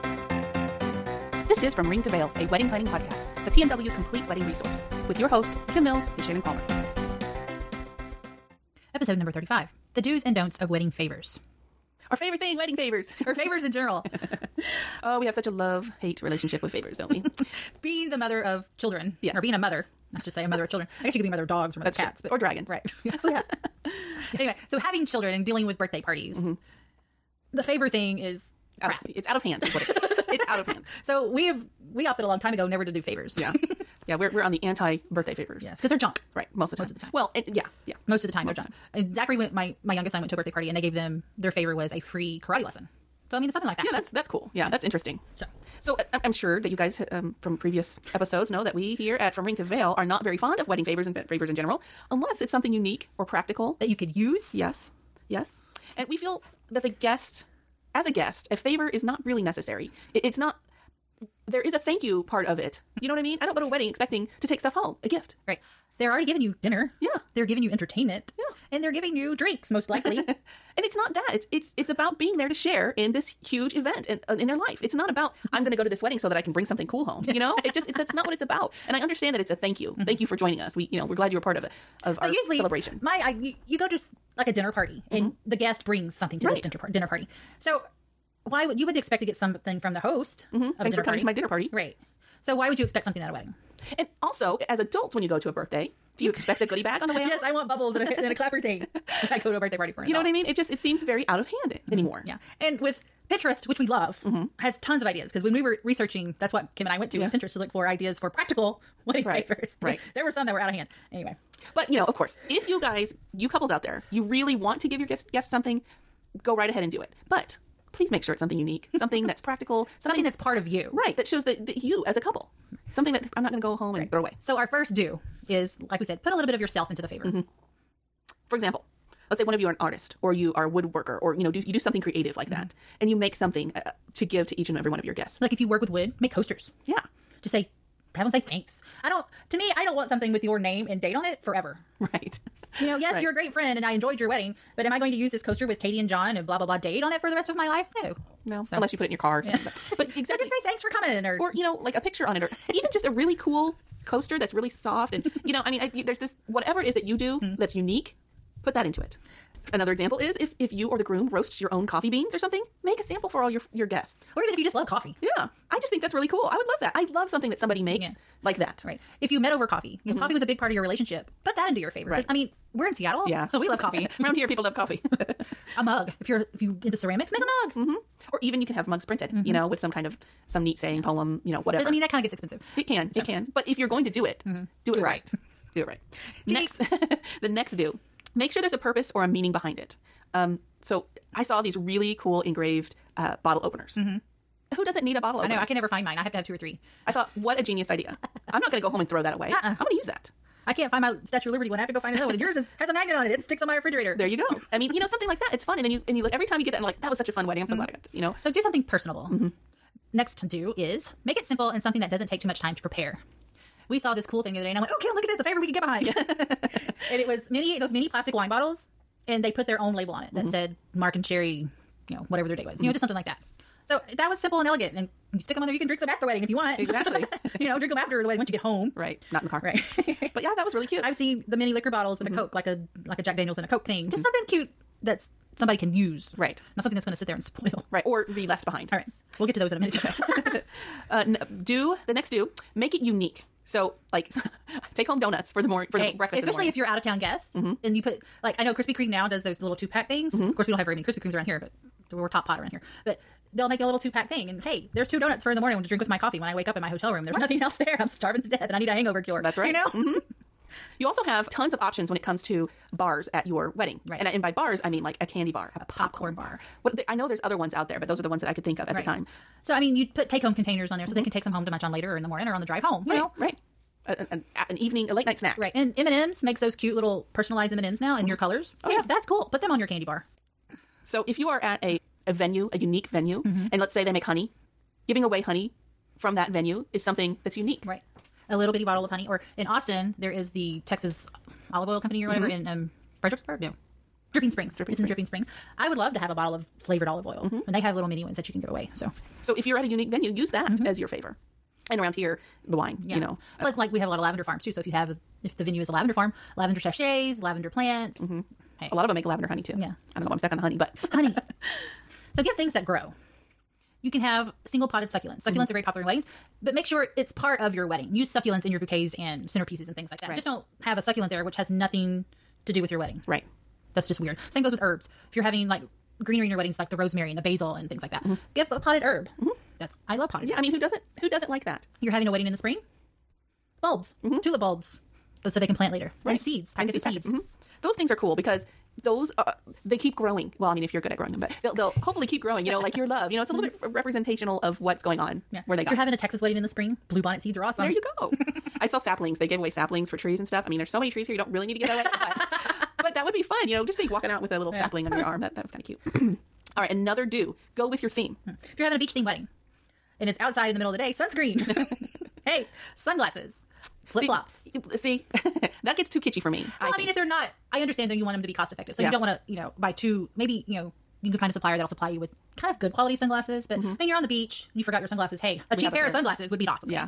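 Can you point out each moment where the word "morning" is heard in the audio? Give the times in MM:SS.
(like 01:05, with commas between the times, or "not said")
04:15, 04:32.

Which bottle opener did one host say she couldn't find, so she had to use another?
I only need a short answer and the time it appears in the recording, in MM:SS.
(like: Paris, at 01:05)
Statue of Liberty one, at 03:21.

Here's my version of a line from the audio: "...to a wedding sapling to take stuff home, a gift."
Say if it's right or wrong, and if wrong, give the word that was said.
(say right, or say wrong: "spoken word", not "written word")
wrong: "expecting", not "sapling".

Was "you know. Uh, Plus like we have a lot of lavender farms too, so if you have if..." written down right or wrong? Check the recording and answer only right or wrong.
right.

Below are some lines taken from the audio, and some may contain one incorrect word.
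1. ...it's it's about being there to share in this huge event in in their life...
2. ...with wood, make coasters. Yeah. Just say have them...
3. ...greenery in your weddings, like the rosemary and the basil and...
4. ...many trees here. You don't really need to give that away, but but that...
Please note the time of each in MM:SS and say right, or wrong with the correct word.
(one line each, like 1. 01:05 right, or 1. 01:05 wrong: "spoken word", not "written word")
1. 01:11 right
2. 02:15 right
3. 05:26 right
4. 05:50 right.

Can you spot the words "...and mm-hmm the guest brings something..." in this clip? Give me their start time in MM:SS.
01:25.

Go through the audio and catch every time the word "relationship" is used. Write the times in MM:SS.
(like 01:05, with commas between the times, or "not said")
00:16, 02:50.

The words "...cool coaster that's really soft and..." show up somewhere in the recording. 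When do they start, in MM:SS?
02:33.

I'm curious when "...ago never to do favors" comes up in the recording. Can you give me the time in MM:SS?
00:32.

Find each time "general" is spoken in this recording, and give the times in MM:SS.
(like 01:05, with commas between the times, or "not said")
00:13, 00:51.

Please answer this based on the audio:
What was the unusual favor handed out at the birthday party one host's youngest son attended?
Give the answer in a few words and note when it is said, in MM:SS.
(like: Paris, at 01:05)
free karate lesson, at 00:41.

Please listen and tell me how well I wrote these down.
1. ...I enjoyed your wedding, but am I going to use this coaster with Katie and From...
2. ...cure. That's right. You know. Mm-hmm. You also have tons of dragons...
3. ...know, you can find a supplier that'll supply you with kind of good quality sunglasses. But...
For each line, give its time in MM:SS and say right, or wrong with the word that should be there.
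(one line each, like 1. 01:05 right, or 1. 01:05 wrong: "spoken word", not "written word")
1. 02:23 wrong: "John", not "From"
2. 04:19 wrong: "options", not "dragons"
3. 06:10 right.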